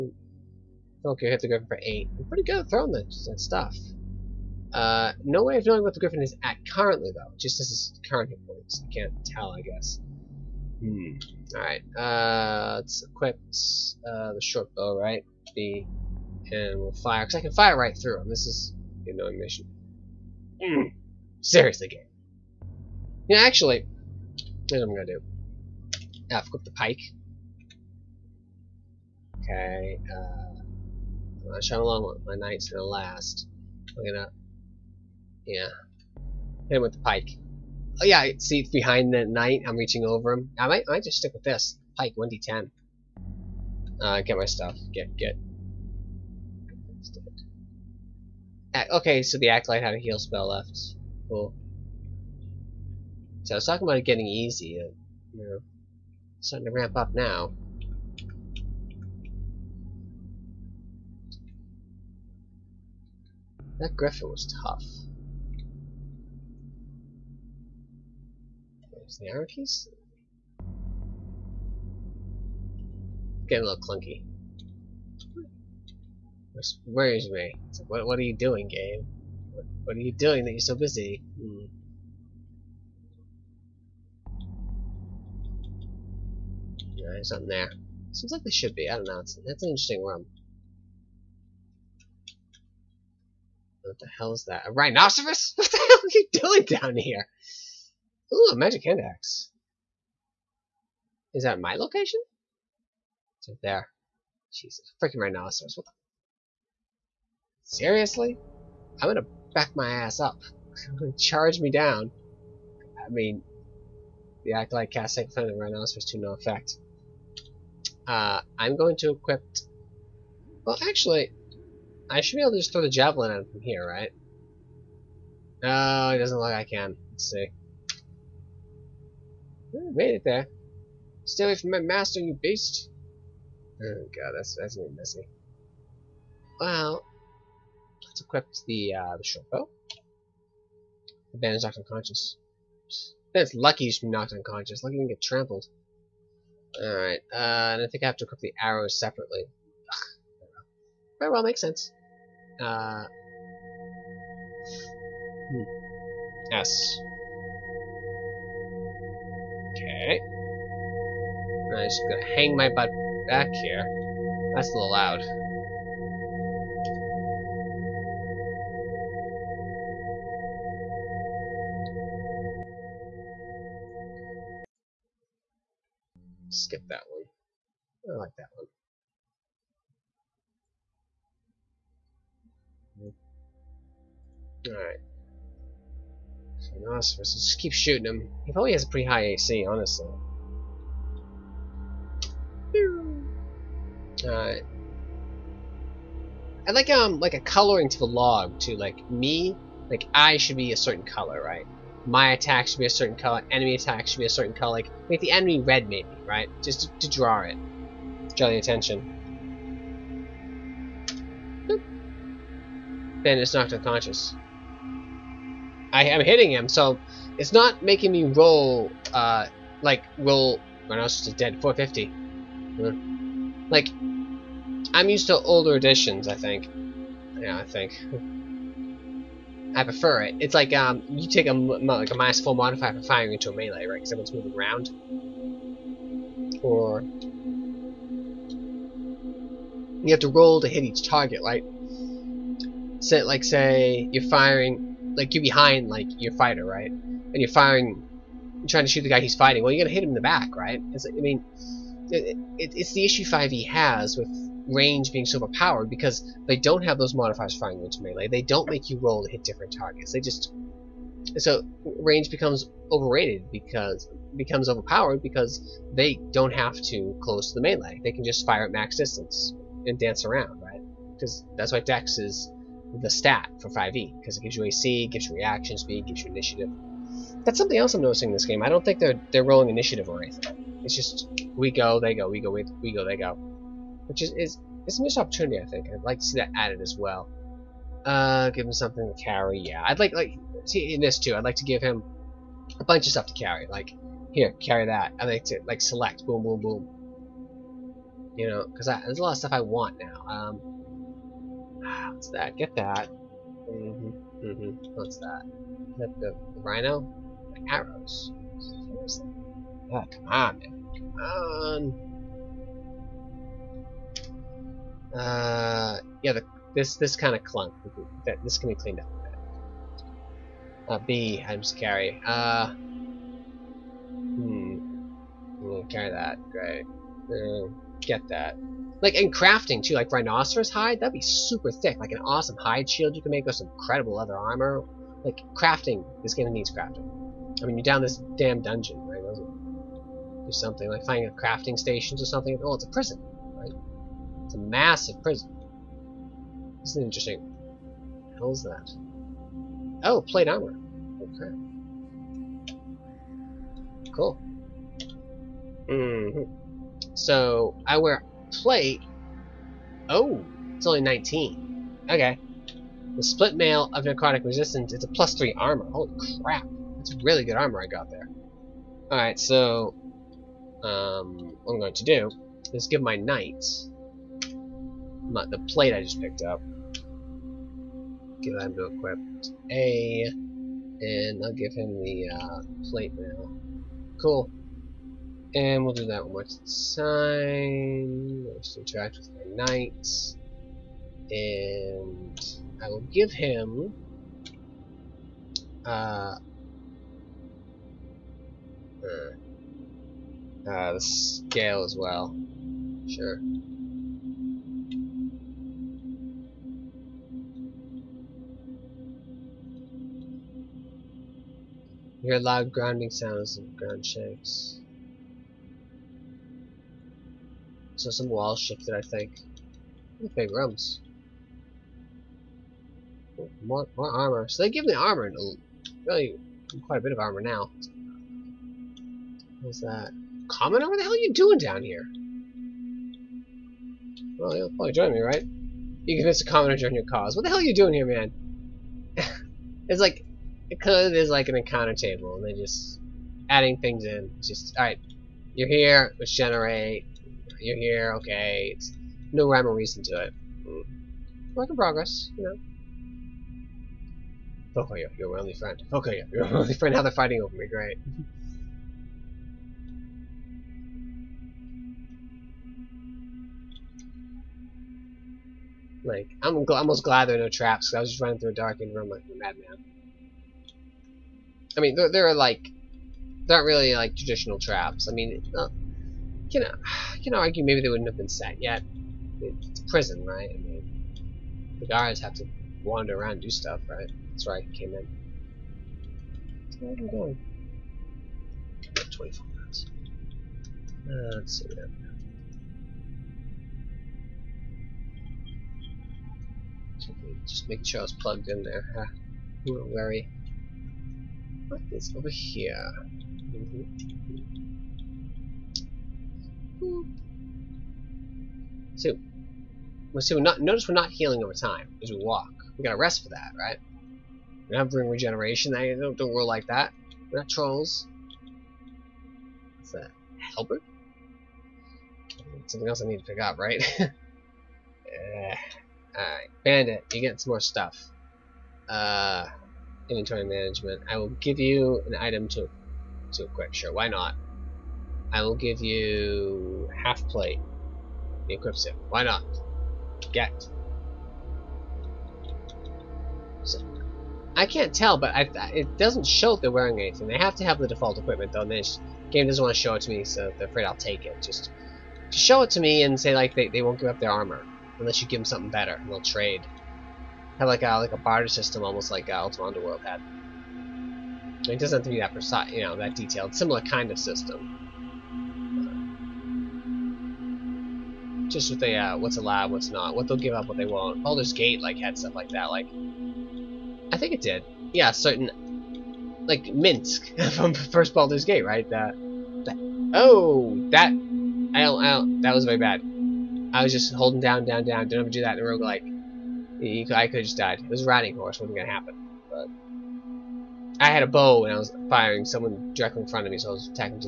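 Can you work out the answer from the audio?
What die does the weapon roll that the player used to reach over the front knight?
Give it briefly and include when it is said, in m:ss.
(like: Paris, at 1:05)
1d10, at 0:41.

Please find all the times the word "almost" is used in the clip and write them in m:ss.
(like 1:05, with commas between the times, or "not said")
7:46, 9:18.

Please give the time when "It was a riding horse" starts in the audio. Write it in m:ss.
9:47.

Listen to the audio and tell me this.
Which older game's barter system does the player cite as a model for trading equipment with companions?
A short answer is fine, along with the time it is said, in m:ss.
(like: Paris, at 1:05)
Ultima Underworld, at 9:19.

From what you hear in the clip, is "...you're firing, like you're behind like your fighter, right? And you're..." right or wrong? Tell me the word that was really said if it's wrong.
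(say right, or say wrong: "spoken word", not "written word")
right.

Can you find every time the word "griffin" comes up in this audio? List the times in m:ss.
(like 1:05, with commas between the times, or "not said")
0:01, 0:06, 1:03.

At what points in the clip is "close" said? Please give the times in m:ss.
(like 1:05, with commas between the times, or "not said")
4:27.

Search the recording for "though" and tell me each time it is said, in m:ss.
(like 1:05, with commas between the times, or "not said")
0:07, 9:08.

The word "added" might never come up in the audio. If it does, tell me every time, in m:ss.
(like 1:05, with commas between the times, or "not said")
4:46.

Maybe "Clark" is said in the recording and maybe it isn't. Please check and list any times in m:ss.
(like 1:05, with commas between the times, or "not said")
not said.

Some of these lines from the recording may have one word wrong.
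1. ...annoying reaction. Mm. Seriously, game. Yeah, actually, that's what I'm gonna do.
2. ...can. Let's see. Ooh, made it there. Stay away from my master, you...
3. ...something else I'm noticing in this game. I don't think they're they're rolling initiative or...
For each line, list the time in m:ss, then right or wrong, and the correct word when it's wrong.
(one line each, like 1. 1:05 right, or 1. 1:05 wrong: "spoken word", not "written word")
1. 0:19 wrong: "mission", not "reaction"
2. 2:06 right
3. 4:37 right.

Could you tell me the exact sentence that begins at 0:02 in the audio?
I'm pretty good at throwing that, that stuff.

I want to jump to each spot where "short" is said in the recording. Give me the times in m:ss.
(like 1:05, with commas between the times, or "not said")
0:14, 2:19.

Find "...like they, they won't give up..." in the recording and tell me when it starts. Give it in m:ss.
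9:13.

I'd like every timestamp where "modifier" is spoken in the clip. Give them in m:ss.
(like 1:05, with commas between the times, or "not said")
3:52, 4:17.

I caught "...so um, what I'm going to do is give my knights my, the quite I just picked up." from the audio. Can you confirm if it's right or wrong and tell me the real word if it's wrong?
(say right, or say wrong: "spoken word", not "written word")
wrong: "plate", not "quite".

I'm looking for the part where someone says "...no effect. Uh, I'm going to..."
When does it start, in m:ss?
1:56.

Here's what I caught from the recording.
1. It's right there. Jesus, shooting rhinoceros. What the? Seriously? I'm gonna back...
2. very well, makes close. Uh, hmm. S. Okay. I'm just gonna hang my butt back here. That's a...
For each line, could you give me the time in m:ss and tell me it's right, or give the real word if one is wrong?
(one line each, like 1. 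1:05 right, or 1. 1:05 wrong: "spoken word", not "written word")
1. 1:43 wrong: "freaking", not "shooting"
2. 2:31 wrong: "sense", not "close".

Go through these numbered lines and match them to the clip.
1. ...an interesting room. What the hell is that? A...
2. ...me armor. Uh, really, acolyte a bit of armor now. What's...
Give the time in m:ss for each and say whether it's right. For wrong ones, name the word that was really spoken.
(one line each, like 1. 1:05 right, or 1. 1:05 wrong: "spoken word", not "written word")
1. 1:29 right
2. 7:04 wrong: "quite", not "acolyte".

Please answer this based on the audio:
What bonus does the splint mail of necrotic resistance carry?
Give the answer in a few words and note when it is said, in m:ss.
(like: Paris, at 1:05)
+3, at 6:05.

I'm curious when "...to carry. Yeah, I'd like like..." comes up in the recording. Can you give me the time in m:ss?
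4:49.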